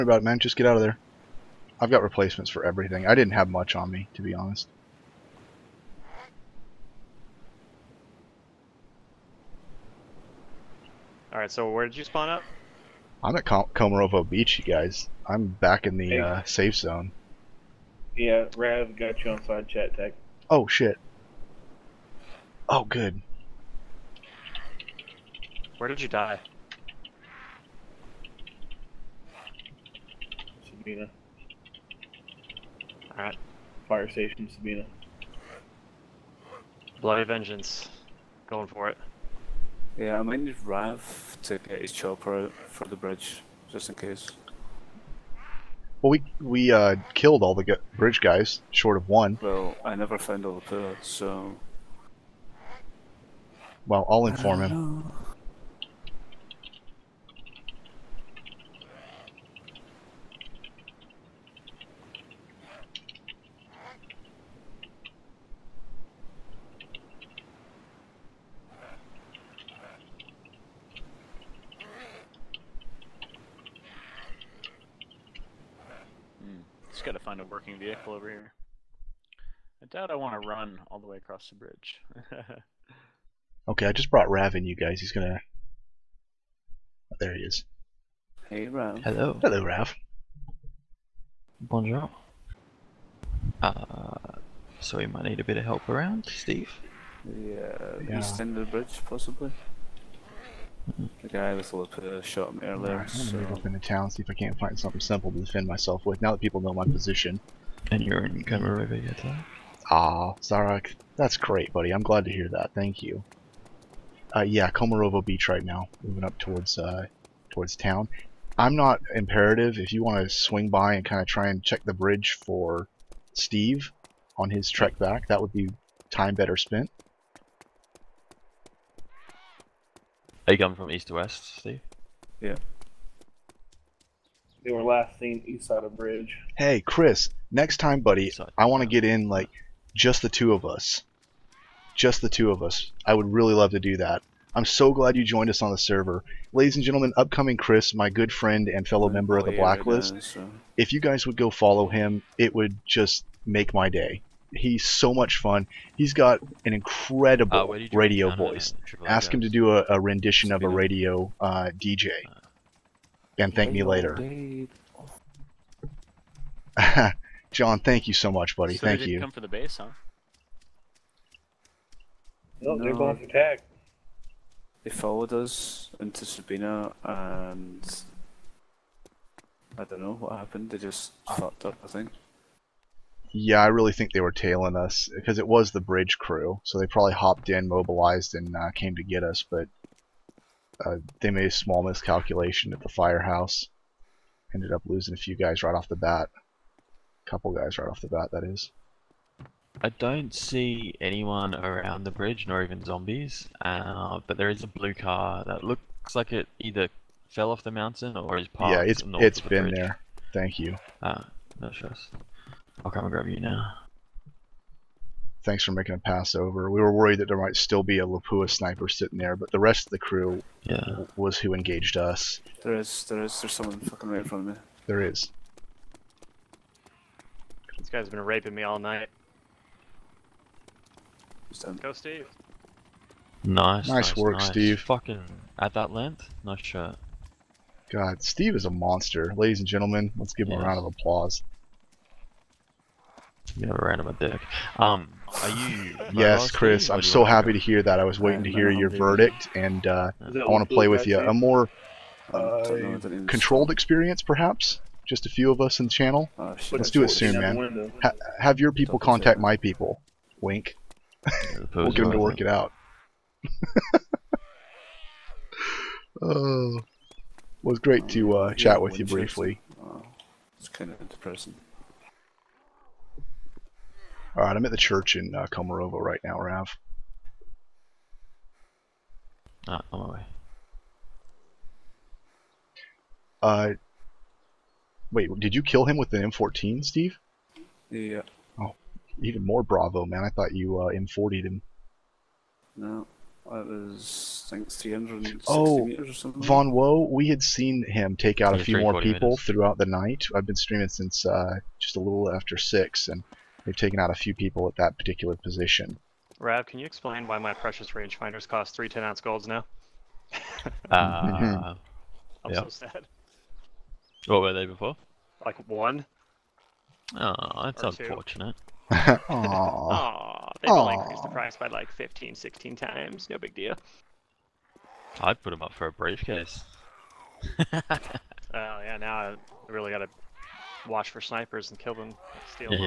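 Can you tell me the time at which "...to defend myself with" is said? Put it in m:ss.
1:45.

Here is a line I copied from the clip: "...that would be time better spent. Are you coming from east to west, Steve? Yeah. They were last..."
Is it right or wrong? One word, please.
right.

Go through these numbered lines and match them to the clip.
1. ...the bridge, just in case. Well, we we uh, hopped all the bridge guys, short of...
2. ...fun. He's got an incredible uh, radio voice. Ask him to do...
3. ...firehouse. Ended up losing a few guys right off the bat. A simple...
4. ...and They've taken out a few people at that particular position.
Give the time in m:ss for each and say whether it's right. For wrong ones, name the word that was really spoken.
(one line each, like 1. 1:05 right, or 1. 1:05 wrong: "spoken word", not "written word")
1. 0:42 wrong: "killed", not "hopped"
2. 2:35 right
3. 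3:12 wrong: "couple", not "simple"
4. 5:03 right.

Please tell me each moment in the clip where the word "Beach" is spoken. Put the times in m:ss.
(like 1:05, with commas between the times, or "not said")
0:14, 1:55.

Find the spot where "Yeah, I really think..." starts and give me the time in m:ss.
3:03.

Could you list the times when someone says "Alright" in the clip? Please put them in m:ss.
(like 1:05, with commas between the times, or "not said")
0:11, 0:33.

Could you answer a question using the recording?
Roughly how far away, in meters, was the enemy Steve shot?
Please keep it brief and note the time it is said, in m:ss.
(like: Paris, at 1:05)
360, at 4:54.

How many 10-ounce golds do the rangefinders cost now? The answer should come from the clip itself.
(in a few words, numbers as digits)
3.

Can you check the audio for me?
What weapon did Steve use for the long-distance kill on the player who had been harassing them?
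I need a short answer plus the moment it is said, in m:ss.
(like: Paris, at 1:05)
M14, at 4:46.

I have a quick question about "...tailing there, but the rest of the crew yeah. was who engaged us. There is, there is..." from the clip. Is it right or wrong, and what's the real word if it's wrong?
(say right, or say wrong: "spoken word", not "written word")
wrong: "sitting", not "tailing".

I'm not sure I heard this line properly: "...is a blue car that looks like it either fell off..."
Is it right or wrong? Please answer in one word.
right.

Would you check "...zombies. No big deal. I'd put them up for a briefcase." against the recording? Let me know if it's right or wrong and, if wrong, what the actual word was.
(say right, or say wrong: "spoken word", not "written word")
wrong: "times", not "zombies".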